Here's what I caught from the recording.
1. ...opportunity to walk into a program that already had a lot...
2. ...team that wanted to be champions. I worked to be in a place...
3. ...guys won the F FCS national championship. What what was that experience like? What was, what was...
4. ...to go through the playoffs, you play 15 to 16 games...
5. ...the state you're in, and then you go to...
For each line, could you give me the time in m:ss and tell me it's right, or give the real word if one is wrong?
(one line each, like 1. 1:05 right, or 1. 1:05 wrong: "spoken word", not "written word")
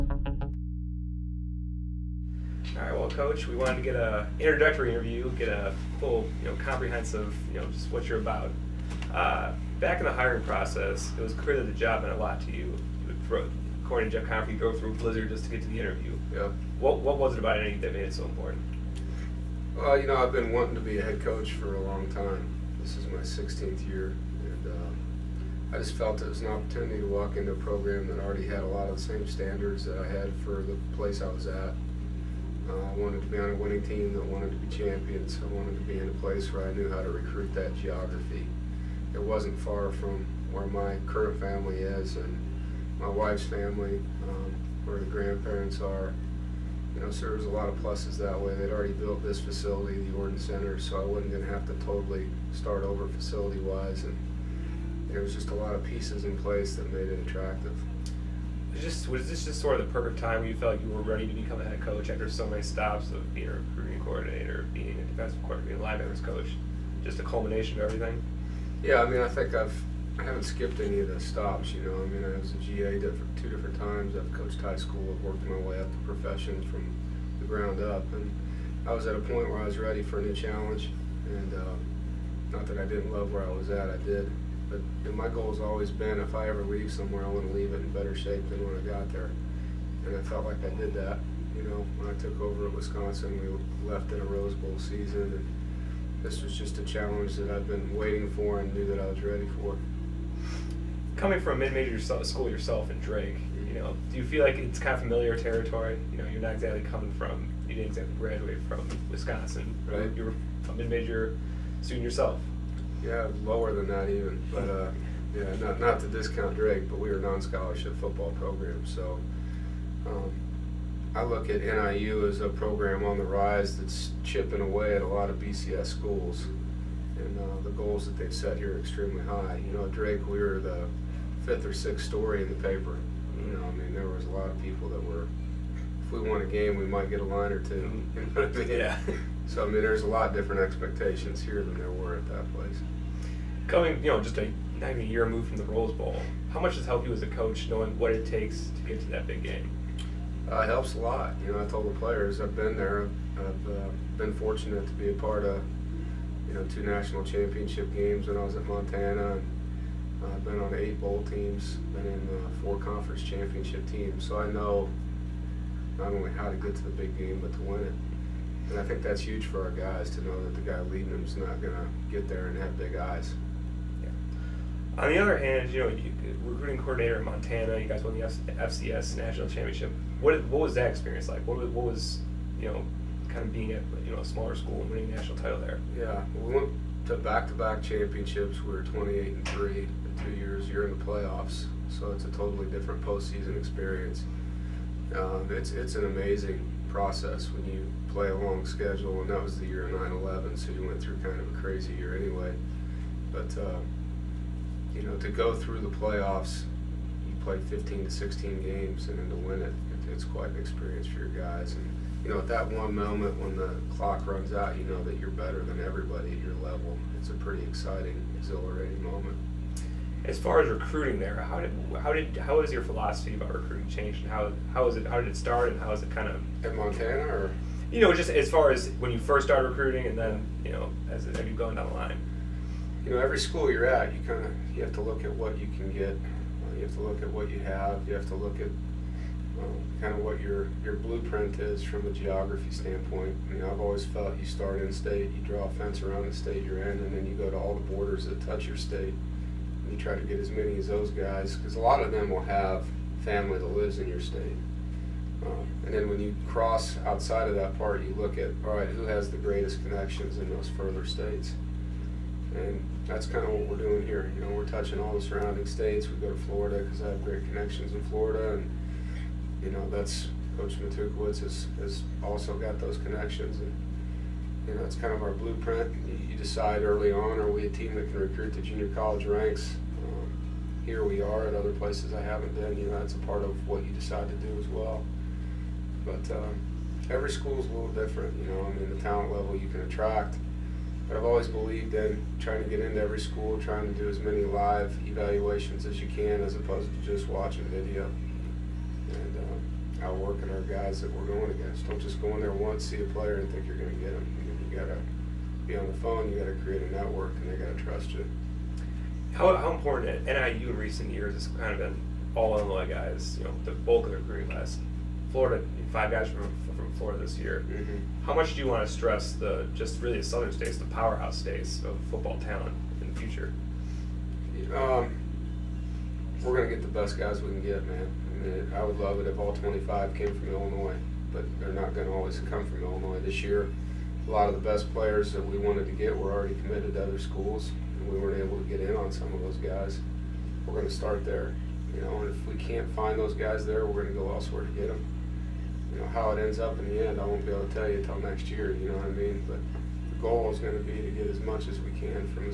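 1. 0:26 right
2. 0:33 wrong: "wanted", not "worked"
3. 2:57 right
4. 3:25 right
5. 4:06 right.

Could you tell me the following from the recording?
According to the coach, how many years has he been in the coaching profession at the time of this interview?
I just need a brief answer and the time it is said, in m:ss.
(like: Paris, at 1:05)
16th year, at 0:23.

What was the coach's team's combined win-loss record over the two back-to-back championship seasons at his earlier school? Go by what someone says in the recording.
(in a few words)
28 and 3.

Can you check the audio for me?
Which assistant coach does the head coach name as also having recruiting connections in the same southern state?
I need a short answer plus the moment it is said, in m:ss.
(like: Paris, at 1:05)
Coach Matukewicz, at 4:30.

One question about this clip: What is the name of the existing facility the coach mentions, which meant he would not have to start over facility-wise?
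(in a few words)
Yordon Center.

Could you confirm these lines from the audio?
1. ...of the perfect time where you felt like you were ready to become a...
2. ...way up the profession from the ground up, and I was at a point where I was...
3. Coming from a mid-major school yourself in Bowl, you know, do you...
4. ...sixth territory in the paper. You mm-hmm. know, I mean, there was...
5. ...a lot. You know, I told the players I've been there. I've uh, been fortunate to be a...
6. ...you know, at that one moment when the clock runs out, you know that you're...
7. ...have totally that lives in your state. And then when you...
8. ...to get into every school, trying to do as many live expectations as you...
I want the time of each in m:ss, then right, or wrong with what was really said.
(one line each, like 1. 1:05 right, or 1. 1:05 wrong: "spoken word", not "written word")
1. 0:59 right
2. 1:15 right
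3. 1:41 wrong: "Drake", not "Bowl"
4. 2:11 wrong: "story", not "territory"
5. 2:30 right
6. 3:32 right
7. 4:12 wrong: "family", not "totally"
8. 4:52 wrong: "evaluations", not "expectations".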